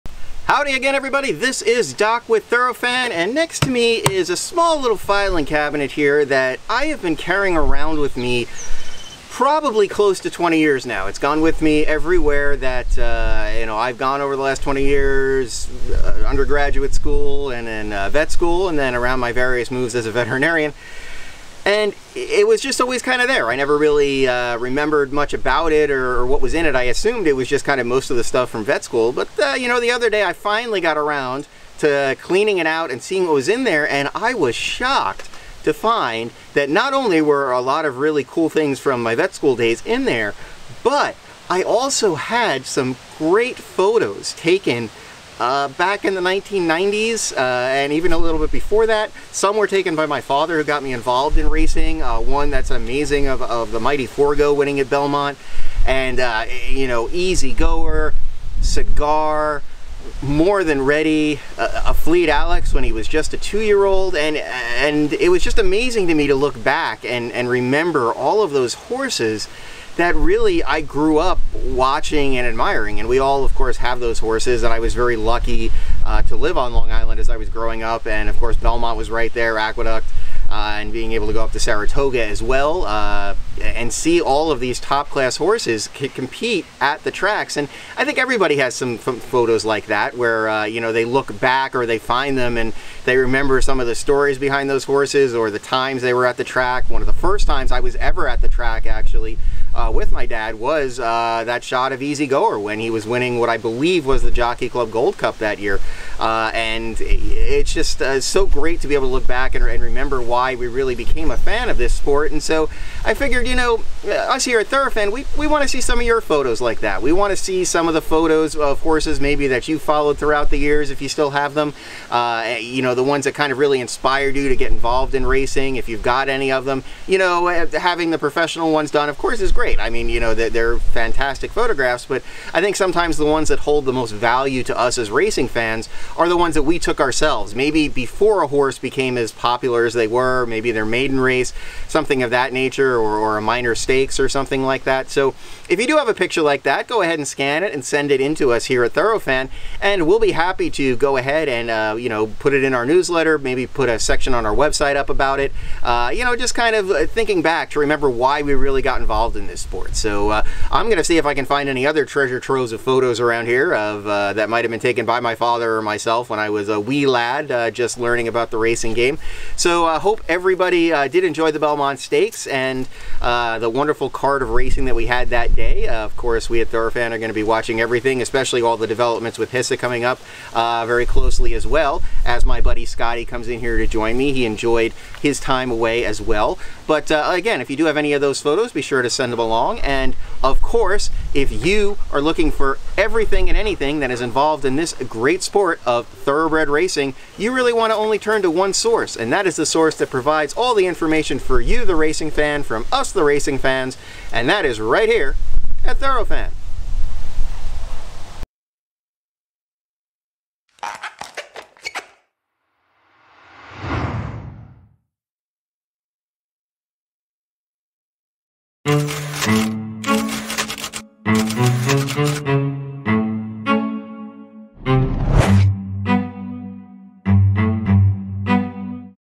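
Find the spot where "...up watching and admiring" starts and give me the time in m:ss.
1:11.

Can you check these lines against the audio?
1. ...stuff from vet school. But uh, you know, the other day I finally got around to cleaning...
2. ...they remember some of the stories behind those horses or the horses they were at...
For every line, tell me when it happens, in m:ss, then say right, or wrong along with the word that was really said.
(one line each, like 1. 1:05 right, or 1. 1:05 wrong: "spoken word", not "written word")
1. 0:28 right
2. 1:33 wrong: "times", not "horses".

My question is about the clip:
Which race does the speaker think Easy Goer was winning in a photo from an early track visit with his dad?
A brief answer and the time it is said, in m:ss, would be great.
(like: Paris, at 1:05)
Jockey Club Gold Cup, at 1:44.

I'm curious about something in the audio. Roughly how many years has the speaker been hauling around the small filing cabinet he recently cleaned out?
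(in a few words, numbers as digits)
20.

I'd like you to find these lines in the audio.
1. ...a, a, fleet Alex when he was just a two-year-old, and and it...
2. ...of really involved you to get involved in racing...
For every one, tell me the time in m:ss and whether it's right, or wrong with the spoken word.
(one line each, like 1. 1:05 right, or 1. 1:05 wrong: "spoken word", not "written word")
1. 1:01 right
2. 2:03 wrong: "inspired", not "involved".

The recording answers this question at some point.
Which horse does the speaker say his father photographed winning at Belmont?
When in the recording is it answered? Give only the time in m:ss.
0:53.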